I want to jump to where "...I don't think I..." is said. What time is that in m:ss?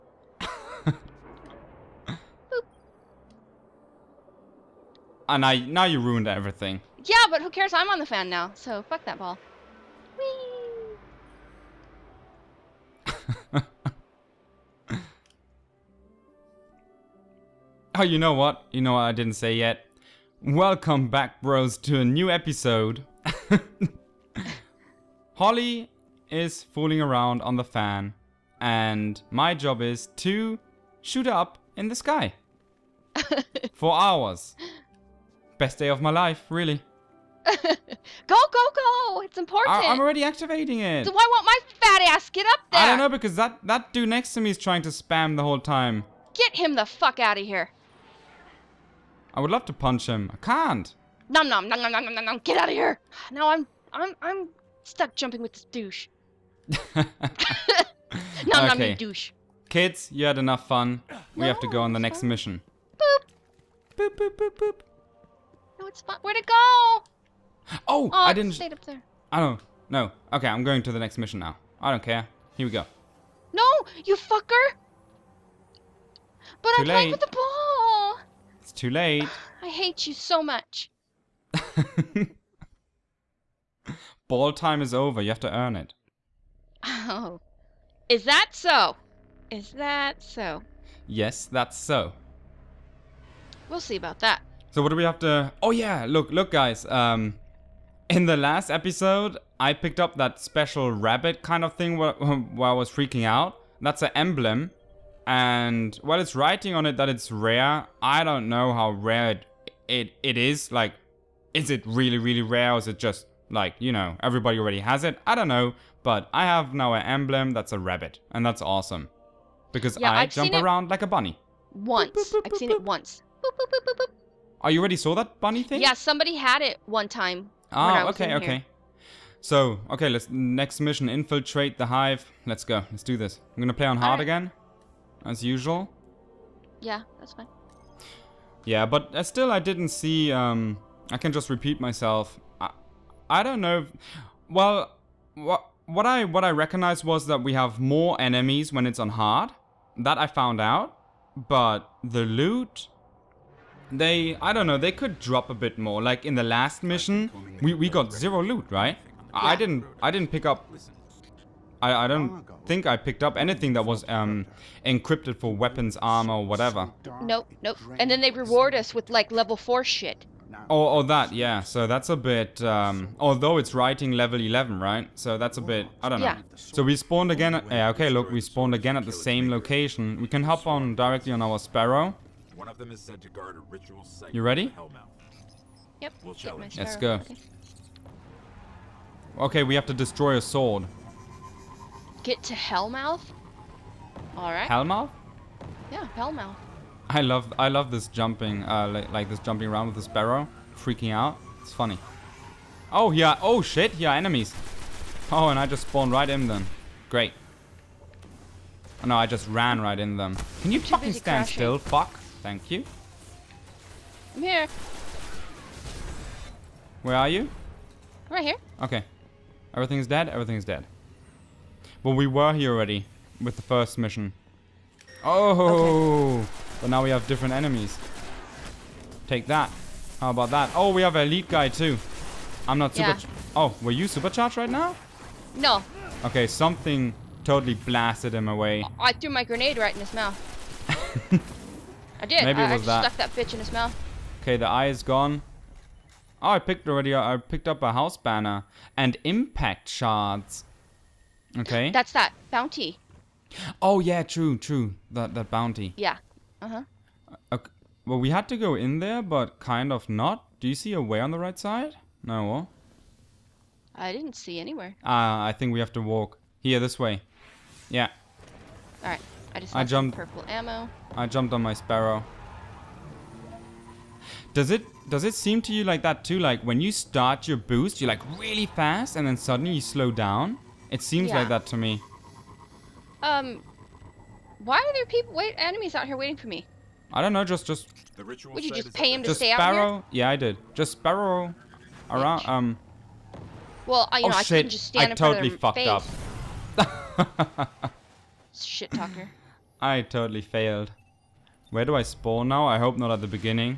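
2:41.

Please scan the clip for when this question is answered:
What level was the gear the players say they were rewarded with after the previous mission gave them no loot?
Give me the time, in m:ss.
2:49.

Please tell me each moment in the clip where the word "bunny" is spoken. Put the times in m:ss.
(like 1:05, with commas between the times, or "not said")
2:01, 2:05.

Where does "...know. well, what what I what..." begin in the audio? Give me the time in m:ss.
2:23.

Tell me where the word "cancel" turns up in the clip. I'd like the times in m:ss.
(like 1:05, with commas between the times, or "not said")
not said.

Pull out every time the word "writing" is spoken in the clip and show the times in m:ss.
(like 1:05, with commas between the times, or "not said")
1:46, 2:53.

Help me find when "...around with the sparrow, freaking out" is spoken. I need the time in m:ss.
3:19.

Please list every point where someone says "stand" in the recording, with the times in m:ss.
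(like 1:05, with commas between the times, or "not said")
3:31, 4:54.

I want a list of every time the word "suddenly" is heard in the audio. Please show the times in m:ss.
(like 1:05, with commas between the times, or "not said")
4:39.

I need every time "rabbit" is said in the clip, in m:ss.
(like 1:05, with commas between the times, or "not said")
1:40, 1:57.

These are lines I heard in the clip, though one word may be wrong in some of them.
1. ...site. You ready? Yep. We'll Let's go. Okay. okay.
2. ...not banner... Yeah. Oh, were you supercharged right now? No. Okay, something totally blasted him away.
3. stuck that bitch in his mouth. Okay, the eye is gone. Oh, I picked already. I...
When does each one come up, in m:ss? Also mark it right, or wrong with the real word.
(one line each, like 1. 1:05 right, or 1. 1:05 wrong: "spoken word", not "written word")
1. 3:04 right
2. 3:52 wrong: "super", not "banner"
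3. 4:03 right.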